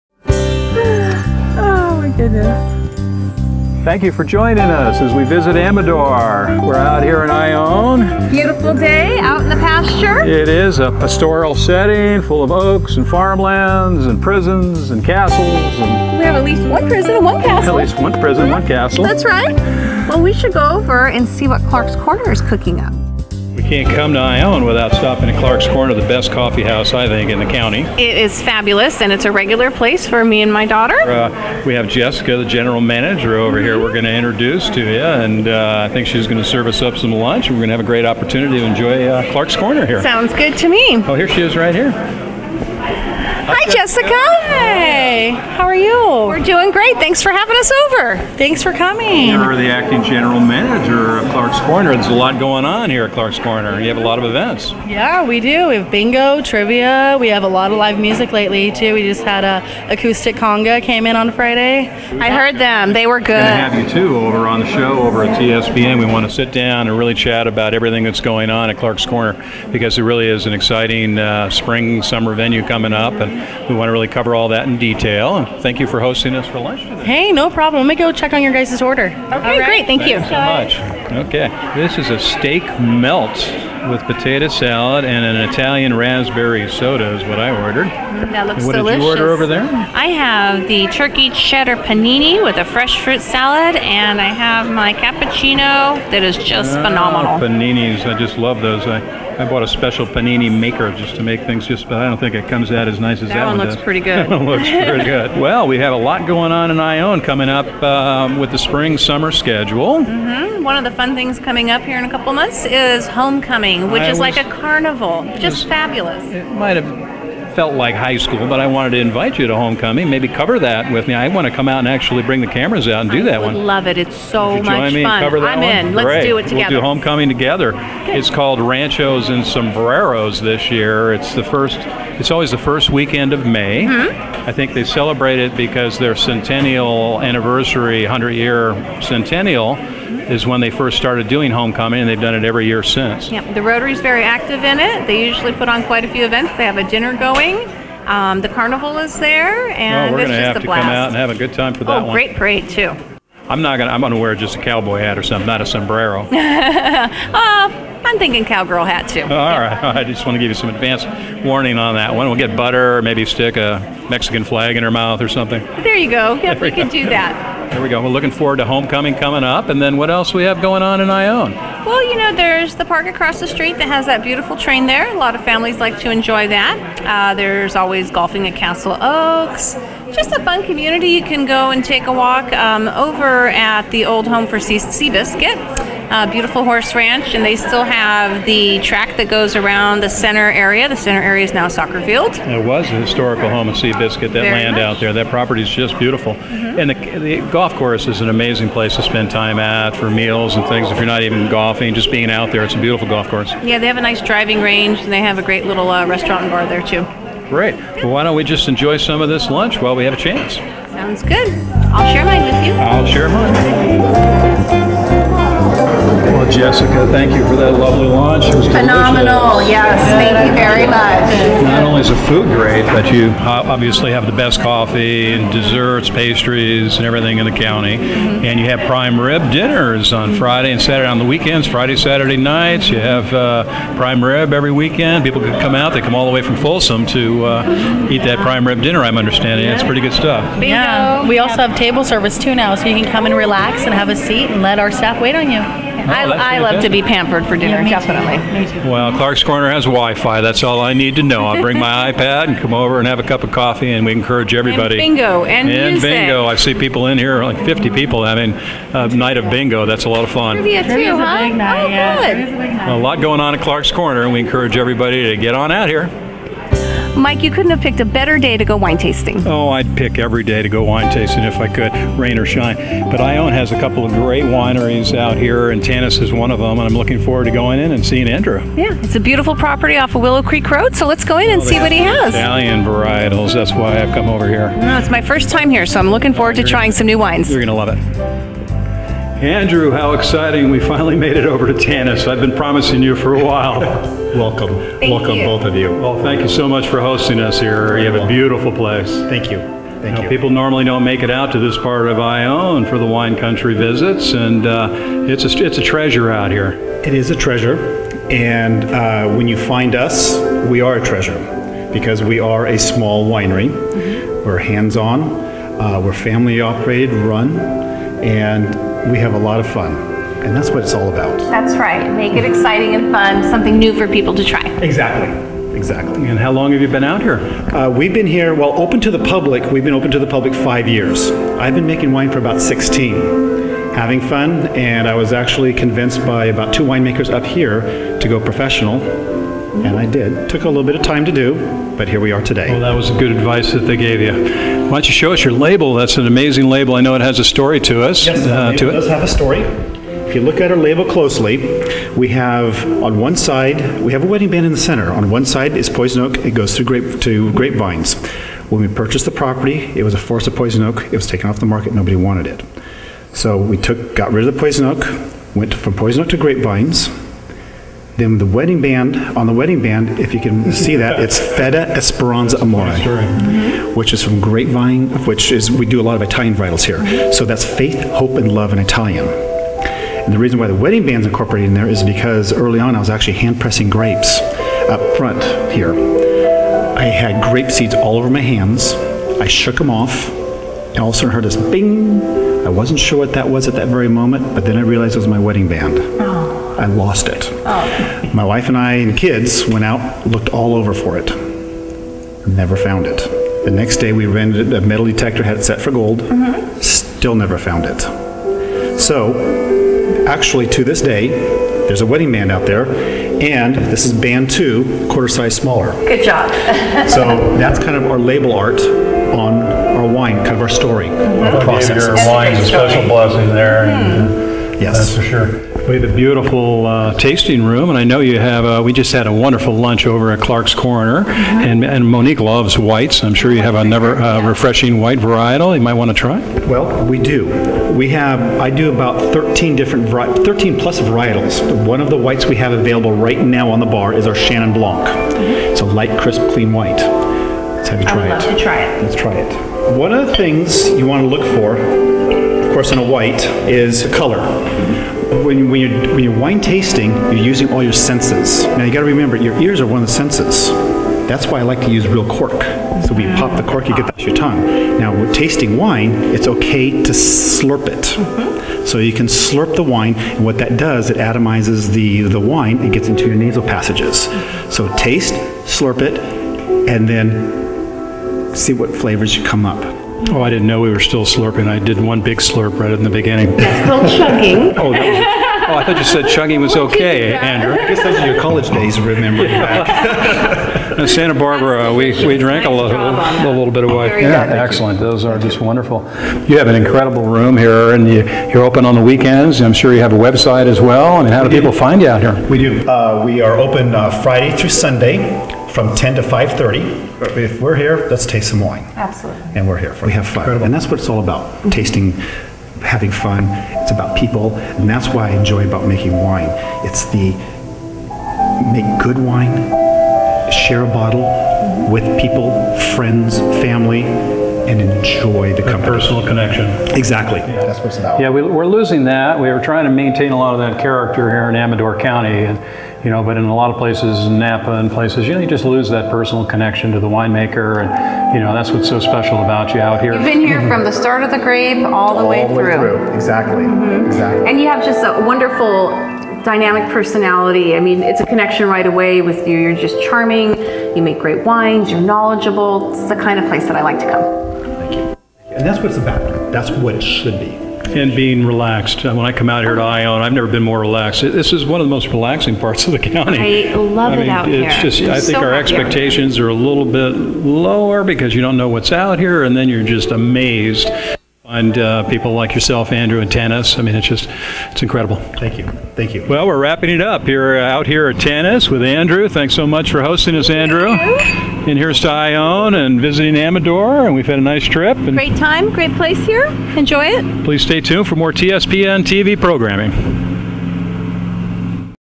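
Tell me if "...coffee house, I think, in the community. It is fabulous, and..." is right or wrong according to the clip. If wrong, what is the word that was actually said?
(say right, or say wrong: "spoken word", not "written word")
wrong: "county", not "community".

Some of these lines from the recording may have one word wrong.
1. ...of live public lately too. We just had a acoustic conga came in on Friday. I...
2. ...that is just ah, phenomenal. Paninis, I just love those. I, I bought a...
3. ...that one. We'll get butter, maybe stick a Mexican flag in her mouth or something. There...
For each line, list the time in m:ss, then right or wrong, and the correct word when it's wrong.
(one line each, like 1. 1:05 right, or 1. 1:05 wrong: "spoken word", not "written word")
1. 0:57 wrong: "music", not "public"
2. 1:36 right
3. 2:41 right.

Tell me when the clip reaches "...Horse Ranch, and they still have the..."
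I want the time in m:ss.
3:06.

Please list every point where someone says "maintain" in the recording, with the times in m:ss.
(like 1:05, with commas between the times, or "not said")
8:49.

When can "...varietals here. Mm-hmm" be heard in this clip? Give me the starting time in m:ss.
6:16.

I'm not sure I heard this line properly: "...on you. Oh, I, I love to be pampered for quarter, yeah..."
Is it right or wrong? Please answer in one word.
wrong.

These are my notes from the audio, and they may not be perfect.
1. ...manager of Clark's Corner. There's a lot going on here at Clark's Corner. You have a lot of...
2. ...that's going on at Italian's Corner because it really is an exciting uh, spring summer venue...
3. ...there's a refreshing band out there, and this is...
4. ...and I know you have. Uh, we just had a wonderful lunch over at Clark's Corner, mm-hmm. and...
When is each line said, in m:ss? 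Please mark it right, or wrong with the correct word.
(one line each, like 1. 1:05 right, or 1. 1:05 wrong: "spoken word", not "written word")
1. 0:50 right
2. 1:08 wrong: "Clark", not "Italian"
3. 6:51 wrong: "wedding", not "refreshing"
4. 7:07 right.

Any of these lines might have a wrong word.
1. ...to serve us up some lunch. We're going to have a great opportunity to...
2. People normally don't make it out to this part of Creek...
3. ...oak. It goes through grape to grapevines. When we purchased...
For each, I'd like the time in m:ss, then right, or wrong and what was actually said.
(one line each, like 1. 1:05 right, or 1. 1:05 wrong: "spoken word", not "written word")
1. 0:36 right
2. 5:00 wrong: "Ione", not "Creek"
3. 5:56 right.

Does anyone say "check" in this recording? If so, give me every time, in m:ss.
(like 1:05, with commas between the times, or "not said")
1:18.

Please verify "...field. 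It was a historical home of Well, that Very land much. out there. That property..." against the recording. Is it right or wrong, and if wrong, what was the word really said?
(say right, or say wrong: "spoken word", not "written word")
wrong: "Seabiscuit", not "Well".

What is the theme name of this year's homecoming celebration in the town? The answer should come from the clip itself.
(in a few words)
Ranchos and Sombreros.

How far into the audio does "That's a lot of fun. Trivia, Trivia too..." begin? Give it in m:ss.
4:19.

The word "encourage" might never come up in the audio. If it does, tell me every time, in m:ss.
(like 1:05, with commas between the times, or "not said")
4:14, 4:24.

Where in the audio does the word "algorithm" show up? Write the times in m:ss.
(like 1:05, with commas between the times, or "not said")
not said.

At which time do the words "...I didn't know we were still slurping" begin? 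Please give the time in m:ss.
8:00.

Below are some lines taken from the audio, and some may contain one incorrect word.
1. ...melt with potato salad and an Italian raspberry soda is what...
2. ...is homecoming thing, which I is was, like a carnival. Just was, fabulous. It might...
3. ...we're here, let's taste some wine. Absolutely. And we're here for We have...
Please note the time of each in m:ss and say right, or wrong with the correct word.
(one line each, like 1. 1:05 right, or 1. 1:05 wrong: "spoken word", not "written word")
1. 1:22 right
2. 1:52 right
3. 8:27 right.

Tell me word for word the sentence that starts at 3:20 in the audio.
If you're not even golfing, just being out there, it's a beautiful golf course.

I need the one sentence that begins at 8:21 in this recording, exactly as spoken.
I mean, how do people find you out here?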